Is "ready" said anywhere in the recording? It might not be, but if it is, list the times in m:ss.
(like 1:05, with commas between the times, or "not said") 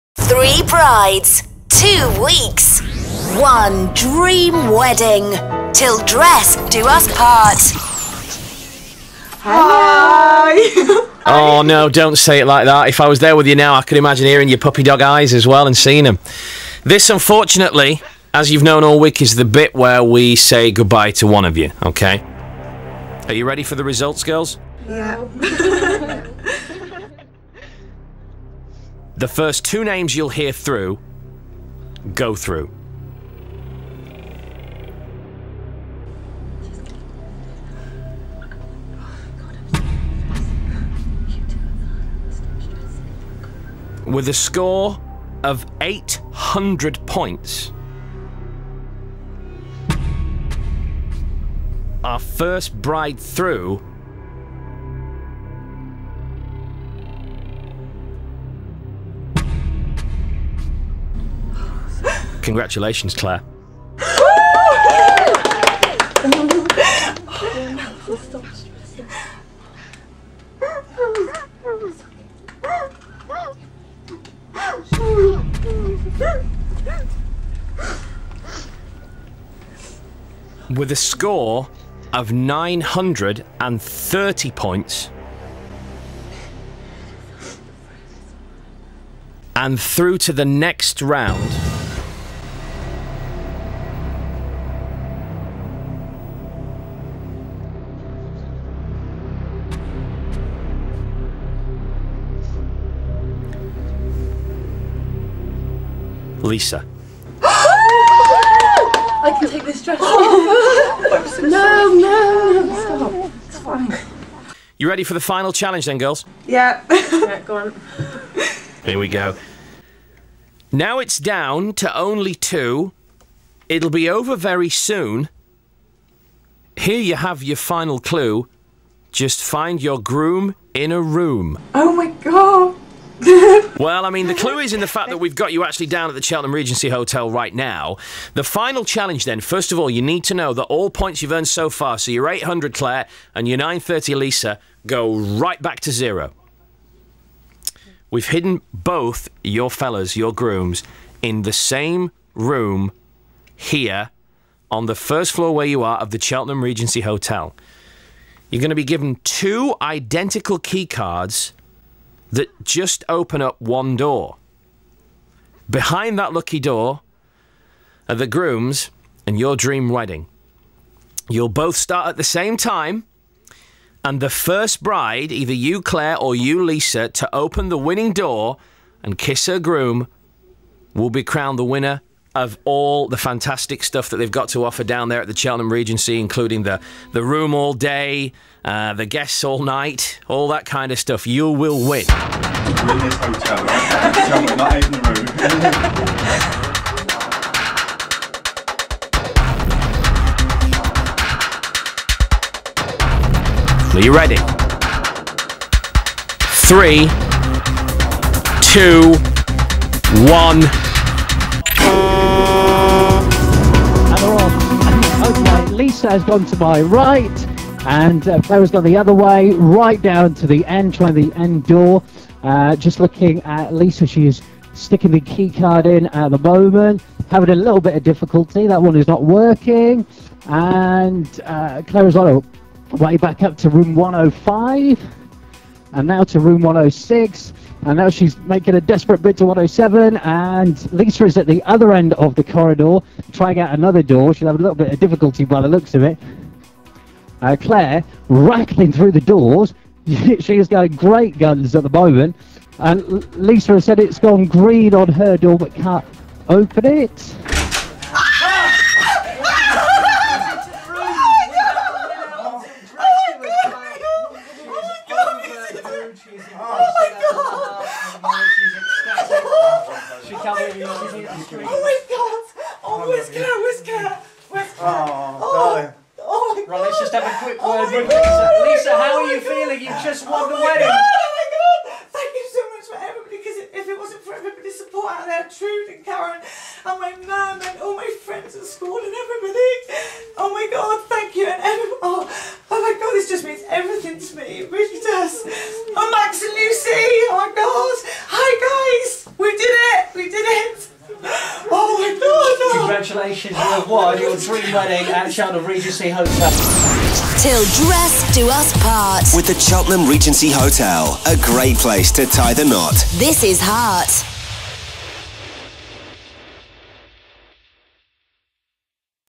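0:23, 1:54, 3:24.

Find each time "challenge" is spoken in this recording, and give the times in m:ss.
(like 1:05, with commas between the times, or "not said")
1:55, 2:18.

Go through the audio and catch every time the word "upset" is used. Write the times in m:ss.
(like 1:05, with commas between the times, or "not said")
not said.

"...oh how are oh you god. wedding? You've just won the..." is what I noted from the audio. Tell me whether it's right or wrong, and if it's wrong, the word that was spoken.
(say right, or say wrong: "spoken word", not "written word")
wrong: "feeling", not "wedding".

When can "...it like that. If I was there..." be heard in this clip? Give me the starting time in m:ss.
0:12.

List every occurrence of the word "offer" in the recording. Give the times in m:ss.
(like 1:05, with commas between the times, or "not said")
3:04.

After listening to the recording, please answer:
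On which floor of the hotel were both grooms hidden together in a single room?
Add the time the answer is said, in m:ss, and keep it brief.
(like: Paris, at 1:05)
first floor, at 2:34.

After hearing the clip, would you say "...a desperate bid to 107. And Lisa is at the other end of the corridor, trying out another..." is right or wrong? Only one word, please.
right.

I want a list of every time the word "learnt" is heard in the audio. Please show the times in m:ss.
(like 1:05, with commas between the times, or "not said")
not said.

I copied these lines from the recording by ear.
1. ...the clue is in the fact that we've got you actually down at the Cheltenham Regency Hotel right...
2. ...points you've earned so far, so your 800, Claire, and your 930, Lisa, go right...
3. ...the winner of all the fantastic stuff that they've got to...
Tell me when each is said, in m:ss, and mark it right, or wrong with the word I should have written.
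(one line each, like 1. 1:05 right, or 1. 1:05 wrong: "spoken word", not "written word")
1. 2:14 right
2. 2:20 right
3. 3:01 right.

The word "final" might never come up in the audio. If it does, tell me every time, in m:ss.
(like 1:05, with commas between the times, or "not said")
1:55, 2:07, 2:18.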